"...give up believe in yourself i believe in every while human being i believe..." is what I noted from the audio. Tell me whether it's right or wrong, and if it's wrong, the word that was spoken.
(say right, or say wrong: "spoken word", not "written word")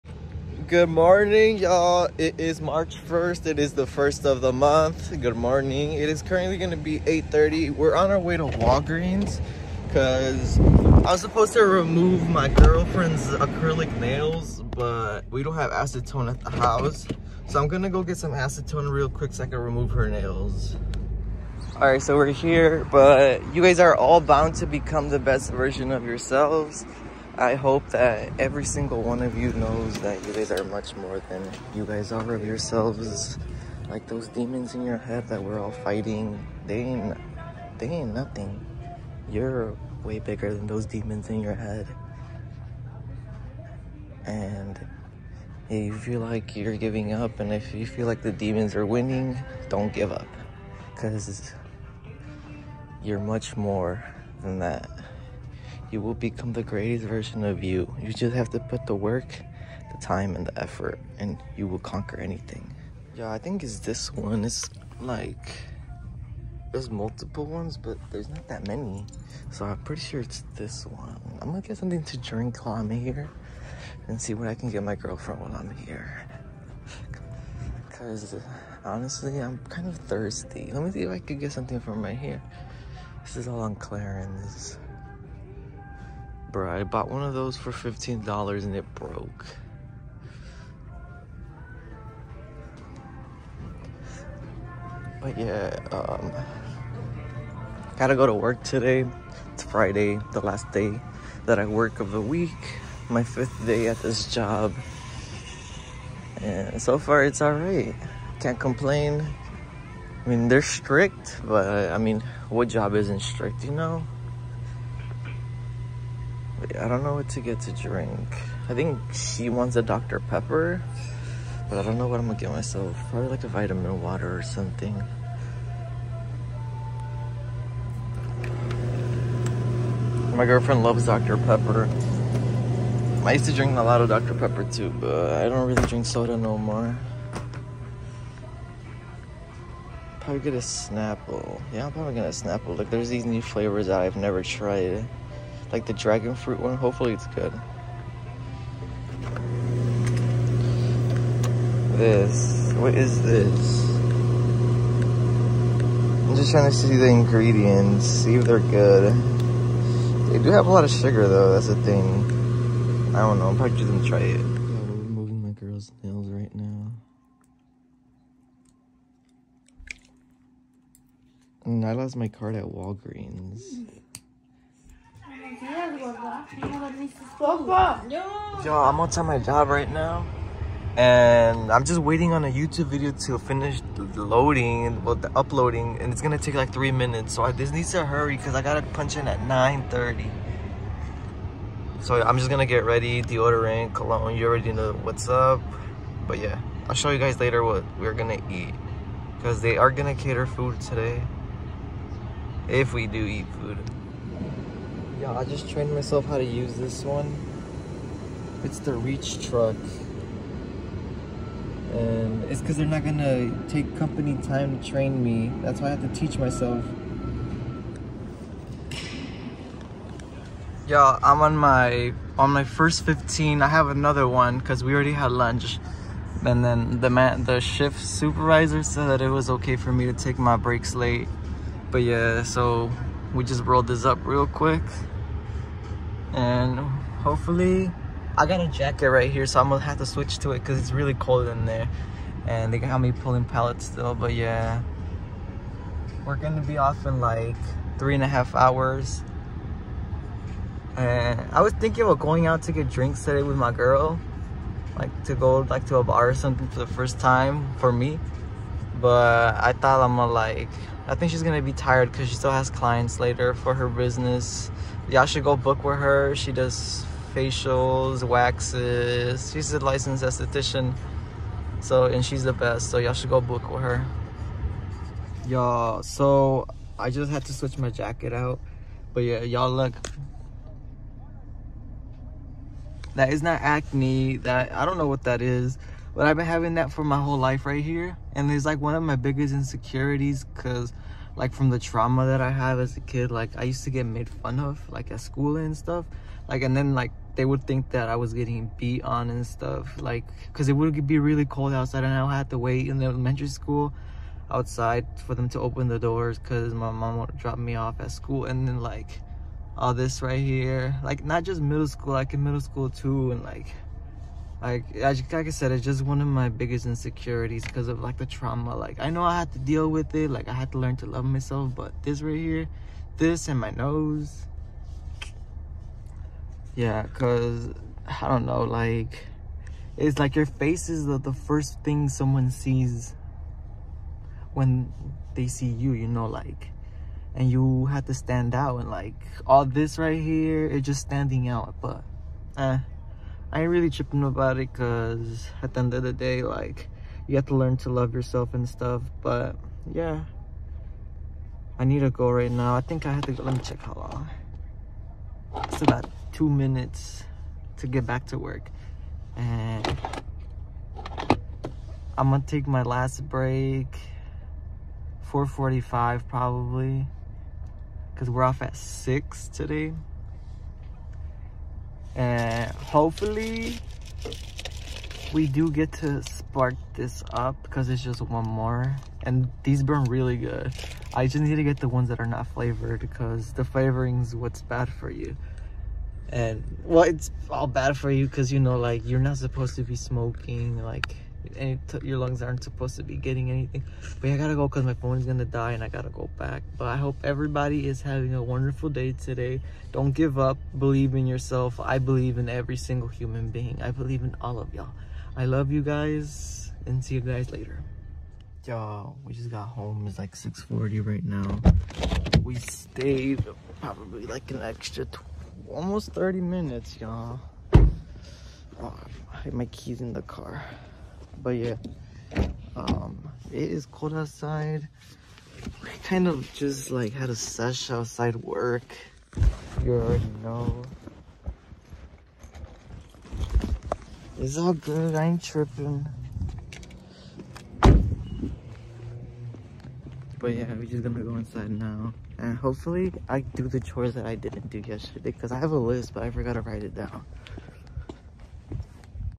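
wrong: "single", not "while".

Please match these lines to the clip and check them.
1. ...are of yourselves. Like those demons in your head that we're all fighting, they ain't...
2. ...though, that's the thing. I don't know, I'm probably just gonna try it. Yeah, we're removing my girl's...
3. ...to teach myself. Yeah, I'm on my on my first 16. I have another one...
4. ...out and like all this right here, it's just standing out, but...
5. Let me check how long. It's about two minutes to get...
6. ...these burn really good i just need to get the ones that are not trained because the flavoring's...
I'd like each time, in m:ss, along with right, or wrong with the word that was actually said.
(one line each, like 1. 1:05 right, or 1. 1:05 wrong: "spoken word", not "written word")
1. 0:32 right
2. 2:41 right
3. 3:36 wrong: "15", not "16"
4. 5:38 right
5. 5:53 right
6. 6:19 wrong: "flavored", not "trained".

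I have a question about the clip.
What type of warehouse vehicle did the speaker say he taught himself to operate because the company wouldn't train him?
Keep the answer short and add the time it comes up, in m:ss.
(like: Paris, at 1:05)
Reach truck, at 3:28.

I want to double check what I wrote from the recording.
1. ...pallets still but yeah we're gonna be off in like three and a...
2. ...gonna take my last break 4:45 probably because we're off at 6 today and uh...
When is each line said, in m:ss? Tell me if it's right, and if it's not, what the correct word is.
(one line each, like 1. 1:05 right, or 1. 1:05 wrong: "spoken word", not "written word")
1. 4:03 right
2. 6:02 right.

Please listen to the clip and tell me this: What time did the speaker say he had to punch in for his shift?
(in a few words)
9:30.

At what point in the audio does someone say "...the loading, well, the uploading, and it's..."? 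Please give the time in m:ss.
3:03.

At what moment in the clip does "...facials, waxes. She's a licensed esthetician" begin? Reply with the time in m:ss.
4:27.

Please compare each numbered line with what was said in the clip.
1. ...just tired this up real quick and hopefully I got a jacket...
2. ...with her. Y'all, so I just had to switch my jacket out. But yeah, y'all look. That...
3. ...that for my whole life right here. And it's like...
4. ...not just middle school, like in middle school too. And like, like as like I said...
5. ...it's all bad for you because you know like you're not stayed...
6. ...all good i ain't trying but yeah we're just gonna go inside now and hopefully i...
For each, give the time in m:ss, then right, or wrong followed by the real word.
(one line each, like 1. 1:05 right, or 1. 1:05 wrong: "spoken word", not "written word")
1. 3:53 wrong: "rolled", not "tired"
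2. 4:33 right
3. 4:46 right
4. 5:11 right
5. 6:27 wrong: "supposed", not "stayed"
6. 7:14 wrong: "tripping", not "trying".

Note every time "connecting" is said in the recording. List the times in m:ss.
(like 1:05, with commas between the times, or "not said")
not said.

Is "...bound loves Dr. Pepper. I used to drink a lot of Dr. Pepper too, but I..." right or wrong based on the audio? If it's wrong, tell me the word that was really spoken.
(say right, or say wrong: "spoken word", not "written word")
wrong: "girlfriend", not "bound".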